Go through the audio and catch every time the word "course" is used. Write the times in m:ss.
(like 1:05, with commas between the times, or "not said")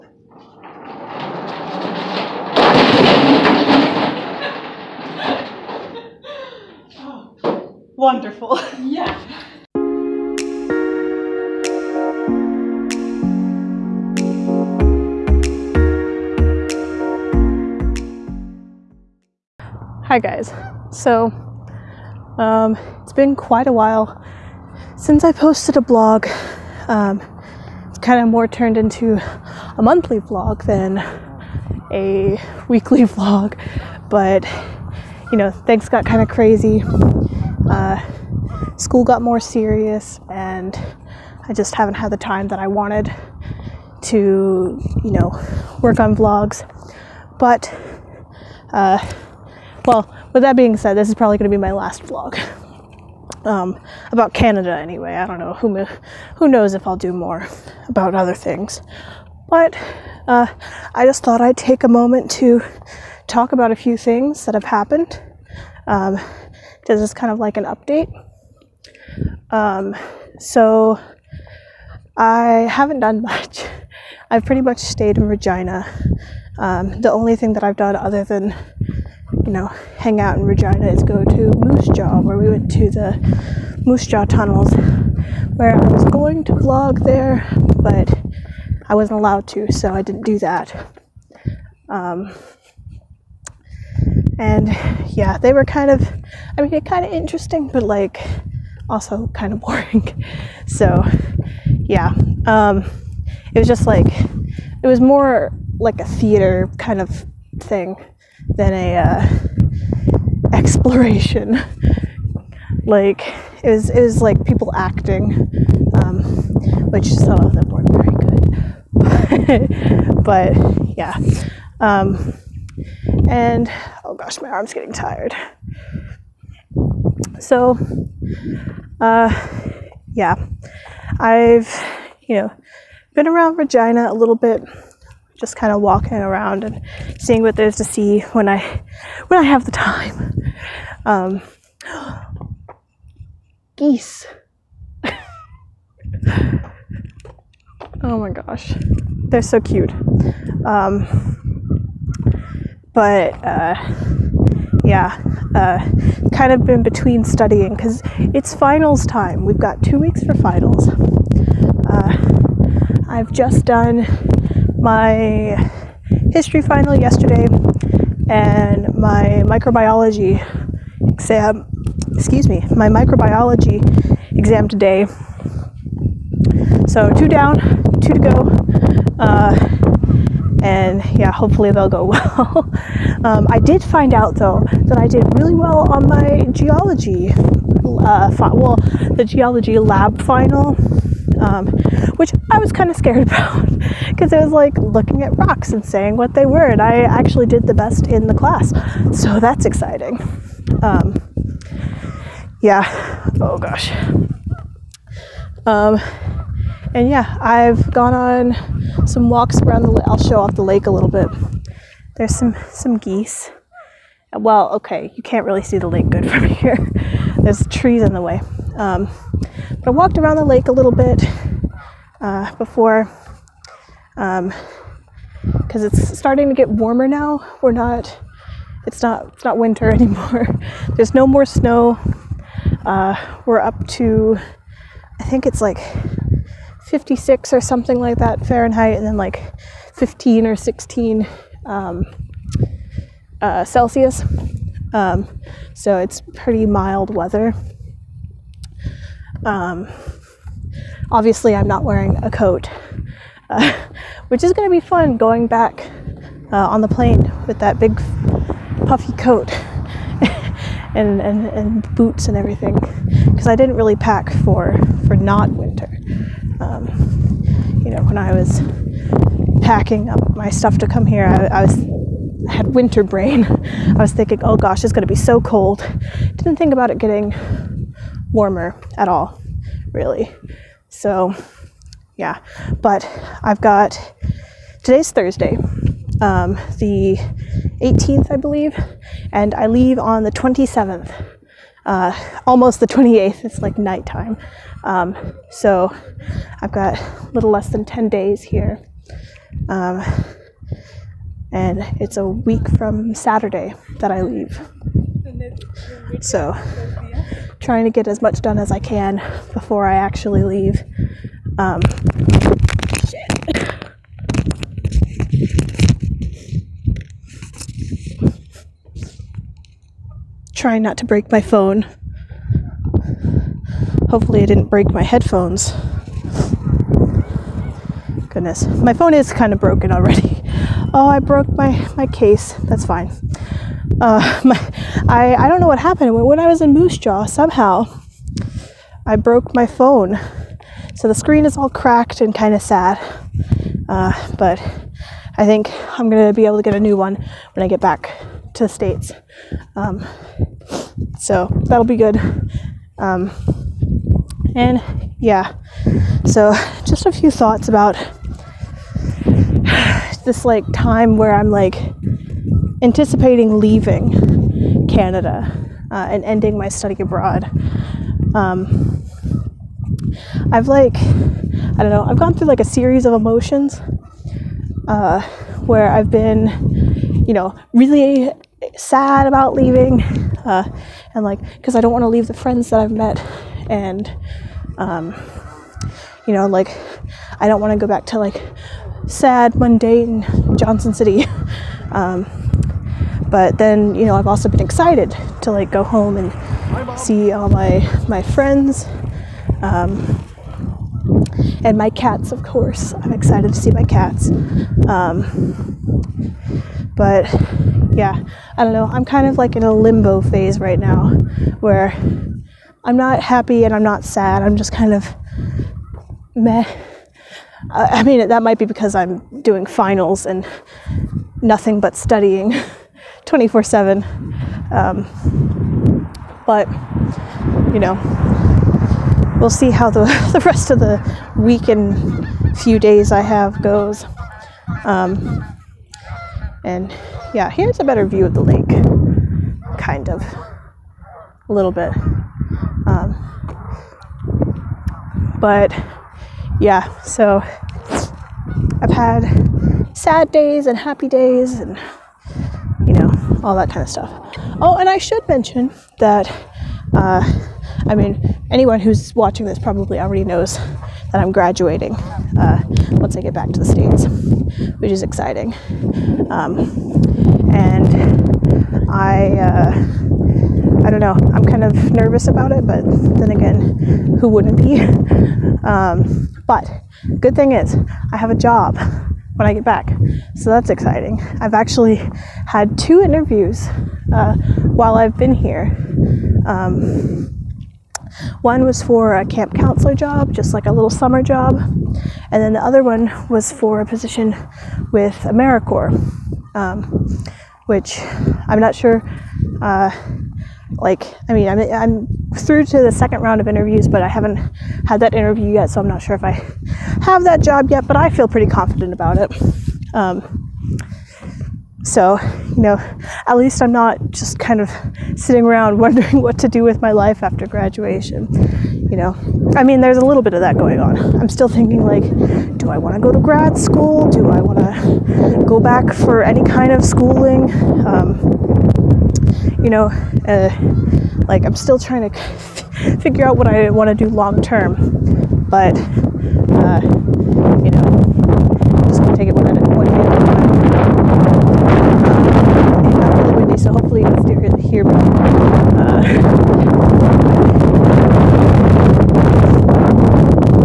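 6:42.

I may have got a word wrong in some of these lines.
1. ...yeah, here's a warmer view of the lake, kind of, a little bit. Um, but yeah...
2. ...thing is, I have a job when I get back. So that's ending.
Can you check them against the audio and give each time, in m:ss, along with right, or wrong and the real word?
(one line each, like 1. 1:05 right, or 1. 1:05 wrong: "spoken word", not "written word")
1. 7:17 wrong: "better", not "warmer"
2. 7:57 wrong: "exciting", not "ending".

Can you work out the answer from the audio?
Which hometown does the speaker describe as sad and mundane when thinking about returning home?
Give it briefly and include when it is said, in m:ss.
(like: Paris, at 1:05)
Johnson City, at 6:30.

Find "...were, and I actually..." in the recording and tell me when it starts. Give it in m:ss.
3:16.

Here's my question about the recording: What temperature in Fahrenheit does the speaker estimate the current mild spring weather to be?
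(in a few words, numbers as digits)
56.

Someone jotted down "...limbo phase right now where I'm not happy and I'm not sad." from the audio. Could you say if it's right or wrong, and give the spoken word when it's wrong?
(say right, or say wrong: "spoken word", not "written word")
right.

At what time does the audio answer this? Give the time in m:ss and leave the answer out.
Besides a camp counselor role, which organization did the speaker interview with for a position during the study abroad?
8:15.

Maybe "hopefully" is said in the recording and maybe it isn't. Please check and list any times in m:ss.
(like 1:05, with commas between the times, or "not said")
3:01, 5:24, 9:03.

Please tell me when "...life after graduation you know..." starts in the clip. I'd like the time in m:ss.
8:36.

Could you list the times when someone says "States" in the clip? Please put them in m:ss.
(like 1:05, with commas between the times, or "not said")
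5:48, 7:43.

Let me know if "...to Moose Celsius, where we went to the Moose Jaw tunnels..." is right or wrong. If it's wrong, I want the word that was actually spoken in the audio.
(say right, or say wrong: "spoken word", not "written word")
wrong: "Jaw", not "Celsius".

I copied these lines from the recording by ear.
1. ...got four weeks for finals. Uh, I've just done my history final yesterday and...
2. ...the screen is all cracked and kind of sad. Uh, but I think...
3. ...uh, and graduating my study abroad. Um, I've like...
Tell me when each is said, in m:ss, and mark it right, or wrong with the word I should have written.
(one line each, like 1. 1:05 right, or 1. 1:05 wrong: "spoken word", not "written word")
1. 2:39 wrong: "two", not "four"
2. 5:41 right
3. 6:05 wrong: "ending", not "graduating".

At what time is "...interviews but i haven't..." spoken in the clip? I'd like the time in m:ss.
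8:23.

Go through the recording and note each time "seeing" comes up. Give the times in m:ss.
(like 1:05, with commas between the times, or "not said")
2:17.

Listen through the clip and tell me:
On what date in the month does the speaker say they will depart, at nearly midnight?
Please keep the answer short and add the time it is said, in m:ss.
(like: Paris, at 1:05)
27th, at 4:50.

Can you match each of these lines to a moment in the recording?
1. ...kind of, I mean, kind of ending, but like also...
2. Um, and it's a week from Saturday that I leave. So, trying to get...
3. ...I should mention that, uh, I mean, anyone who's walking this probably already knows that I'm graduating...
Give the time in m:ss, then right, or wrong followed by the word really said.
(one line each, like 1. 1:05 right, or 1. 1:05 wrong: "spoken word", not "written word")
1. 1:35 wrong: "interesting", not "ending"
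2. 4:59 right
3. 7:34 wrong: "watching", not "walking".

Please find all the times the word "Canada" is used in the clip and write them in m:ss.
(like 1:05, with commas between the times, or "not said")
0:54, 6:04.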